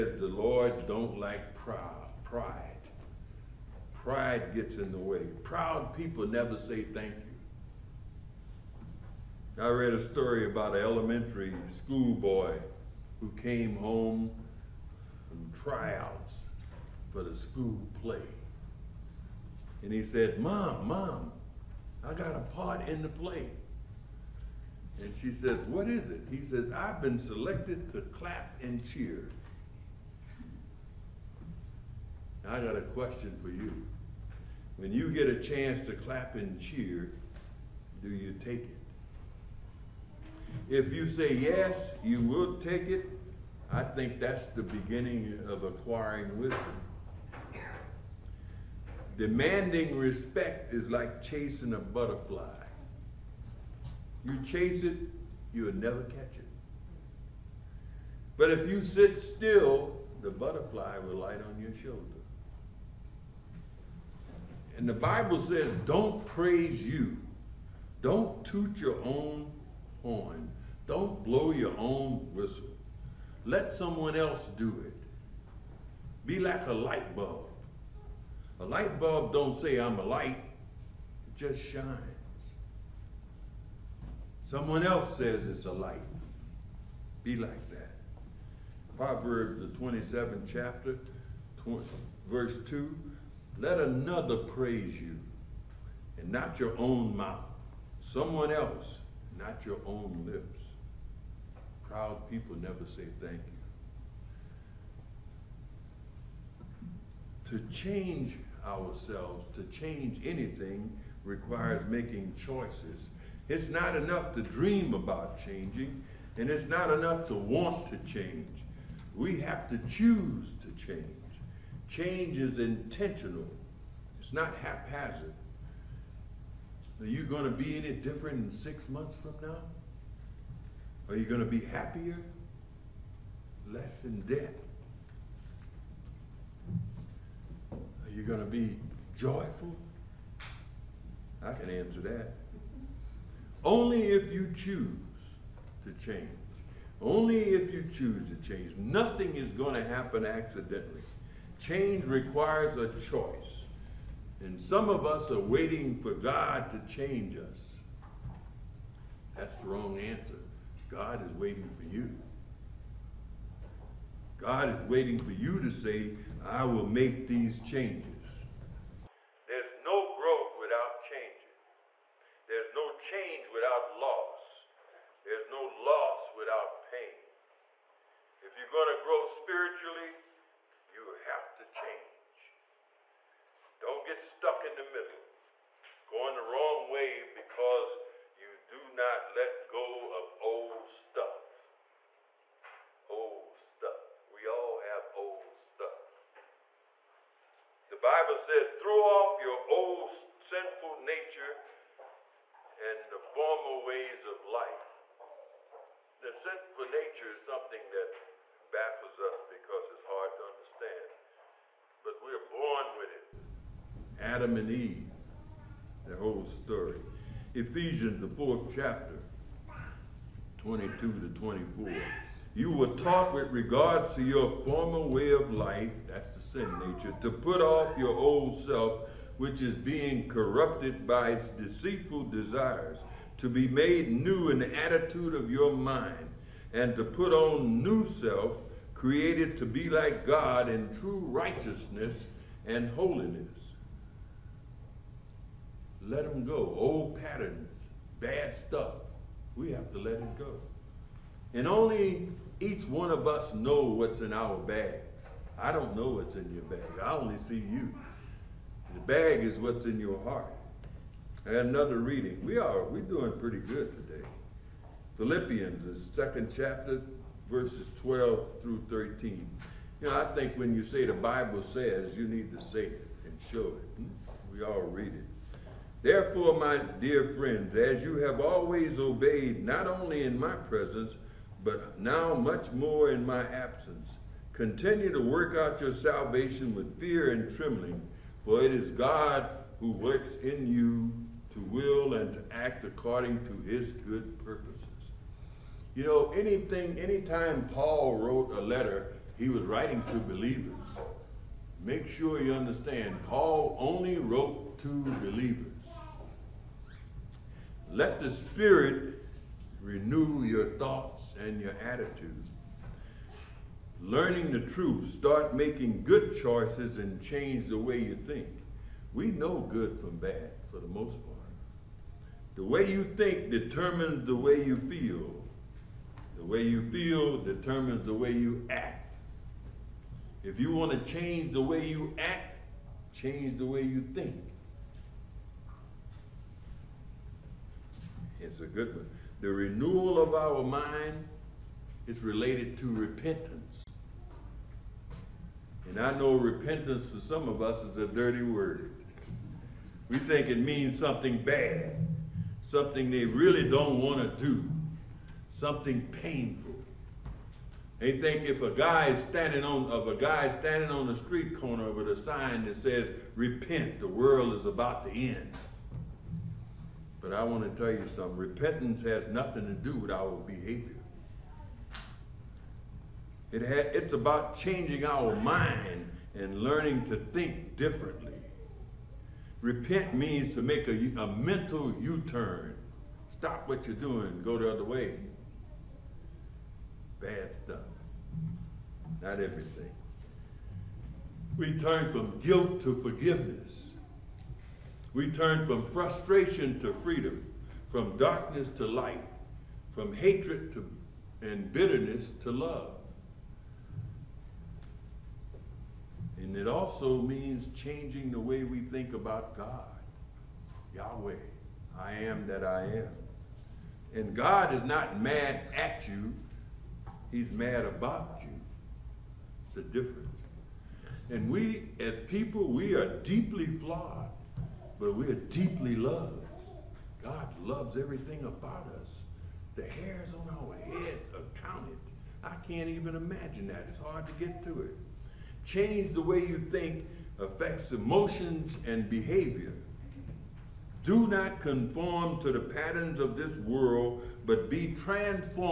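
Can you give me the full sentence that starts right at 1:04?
And the Bible says, don't praise you.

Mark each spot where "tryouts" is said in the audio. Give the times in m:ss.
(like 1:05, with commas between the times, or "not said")
0:15.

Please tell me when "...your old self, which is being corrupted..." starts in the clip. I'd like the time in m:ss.
3:47.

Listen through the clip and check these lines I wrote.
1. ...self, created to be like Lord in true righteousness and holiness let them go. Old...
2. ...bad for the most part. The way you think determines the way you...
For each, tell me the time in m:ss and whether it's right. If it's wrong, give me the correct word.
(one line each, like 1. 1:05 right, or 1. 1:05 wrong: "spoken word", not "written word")
1. 3:58 wrong: "God", not "Lord"
2. 5:20 right.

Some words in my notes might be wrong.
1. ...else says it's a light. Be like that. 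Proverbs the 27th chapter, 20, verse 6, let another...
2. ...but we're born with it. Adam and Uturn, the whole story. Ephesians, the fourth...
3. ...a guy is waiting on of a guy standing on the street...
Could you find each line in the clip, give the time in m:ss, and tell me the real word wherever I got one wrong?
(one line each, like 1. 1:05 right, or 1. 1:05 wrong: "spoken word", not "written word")
1. 1:24 wrong: "2", not "6"
2. 3:32 wrong: "Eve", not "Uturn"
3. 5:58 wrong: "standing", not "waiting".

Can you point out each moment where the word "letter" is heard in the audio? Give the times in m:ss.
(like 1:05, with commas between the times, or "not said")
4:58.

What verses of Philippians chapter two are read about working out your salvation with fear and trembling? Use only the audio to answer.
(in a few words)
12 through 13.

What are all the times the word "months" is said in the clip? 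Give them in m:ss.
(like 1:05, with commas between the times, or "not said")
2:08.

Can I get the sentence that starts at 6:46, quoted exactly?
And it also means changing the way we think about God.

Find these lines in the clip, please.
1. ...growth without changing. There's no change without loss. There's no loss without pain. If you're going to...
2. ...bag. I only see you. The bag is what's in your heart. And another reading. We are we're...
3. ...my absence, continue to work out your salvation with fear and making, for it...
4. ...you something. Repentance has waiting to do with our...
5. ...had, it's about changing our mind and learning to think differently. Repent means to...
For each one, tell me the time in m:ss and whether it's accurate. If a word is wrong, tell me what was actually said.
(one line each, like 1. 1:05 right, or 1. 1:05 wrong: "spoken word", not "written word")
1. 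2:50 right
2. 4:16 right
3. 4:43 wrong: "trembling", not "making"
4. 6:07 wrong: "nothing", not "waiting"
5. 6:13 right.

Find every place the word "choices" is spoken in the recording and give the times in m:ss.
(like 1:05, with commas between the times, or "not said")
1:52, 2:32, 5:16.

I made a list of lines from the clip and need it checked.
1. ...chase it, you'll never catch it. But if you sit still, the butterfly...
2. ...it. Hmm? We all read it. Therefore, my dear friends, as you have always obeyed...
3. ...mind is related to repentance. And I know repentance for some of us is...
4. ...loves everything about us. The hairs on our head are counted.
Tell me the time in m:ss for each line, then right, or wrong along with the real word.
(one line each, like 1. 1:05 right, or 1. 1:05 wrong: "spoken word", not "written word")
1. 0:54 right
2. 4:33 right
3. 5:40 right
4. 7:07 right.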